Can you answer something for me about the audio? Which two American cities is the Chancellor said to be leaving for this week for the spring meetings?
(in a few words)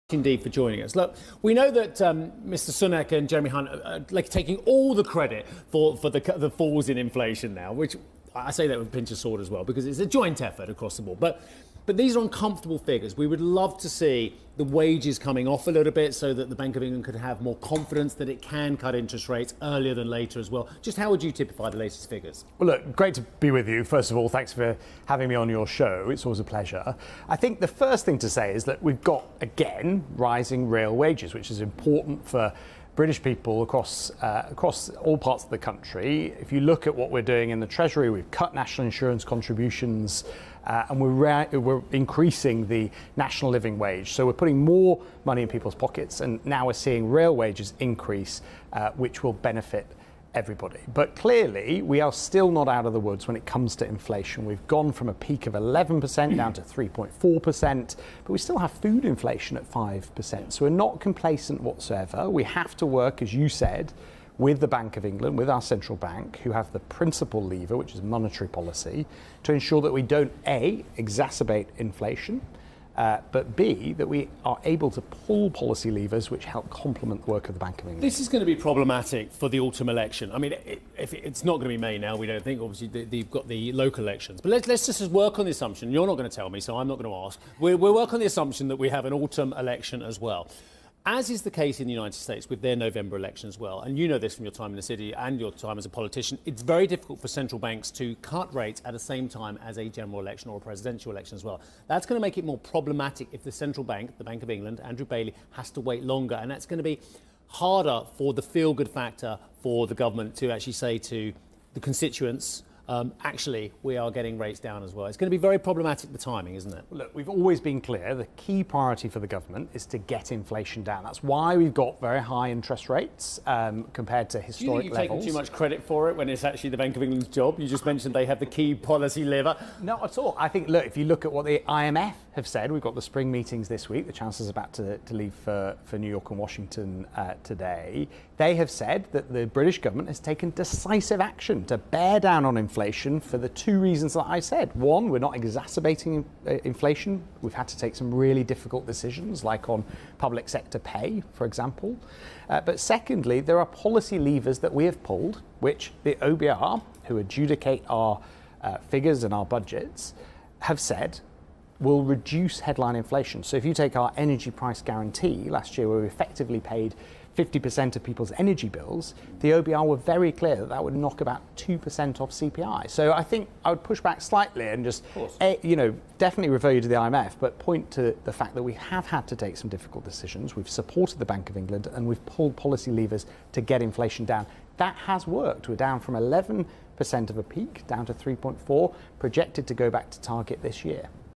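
New York and Washington.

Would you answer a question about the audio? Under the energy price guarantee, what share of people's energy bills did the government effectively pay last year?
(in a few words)
50%.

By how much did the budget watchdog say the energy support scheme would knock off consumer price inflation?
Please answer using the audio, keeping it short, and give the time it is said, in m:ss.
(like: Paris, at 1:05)
2%, at 2:51.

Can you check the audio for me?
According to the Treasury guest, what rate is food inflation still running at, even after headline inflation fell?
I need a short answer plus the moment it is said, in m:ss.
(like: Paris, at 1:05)
5%, at 0:59.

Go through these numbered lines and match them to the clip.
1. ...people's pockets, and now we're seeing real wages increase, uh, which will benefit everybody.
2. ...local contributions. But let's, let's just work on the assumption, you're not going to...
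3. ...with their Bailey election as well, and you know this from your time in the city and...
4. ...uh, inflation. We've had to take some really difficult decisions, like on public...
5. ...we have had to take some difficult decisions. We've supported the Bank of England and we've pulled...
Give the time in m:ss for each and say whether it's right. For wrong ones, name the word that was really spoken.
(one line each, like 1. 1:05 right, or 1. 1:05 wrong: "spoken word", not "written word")
1. 0:45 right
2. 1:23 wrong: "elections", not "contributions"
3. 1:32 wrong: "November", not "Bailey"
4. 2:26 right
5. 2:58 right.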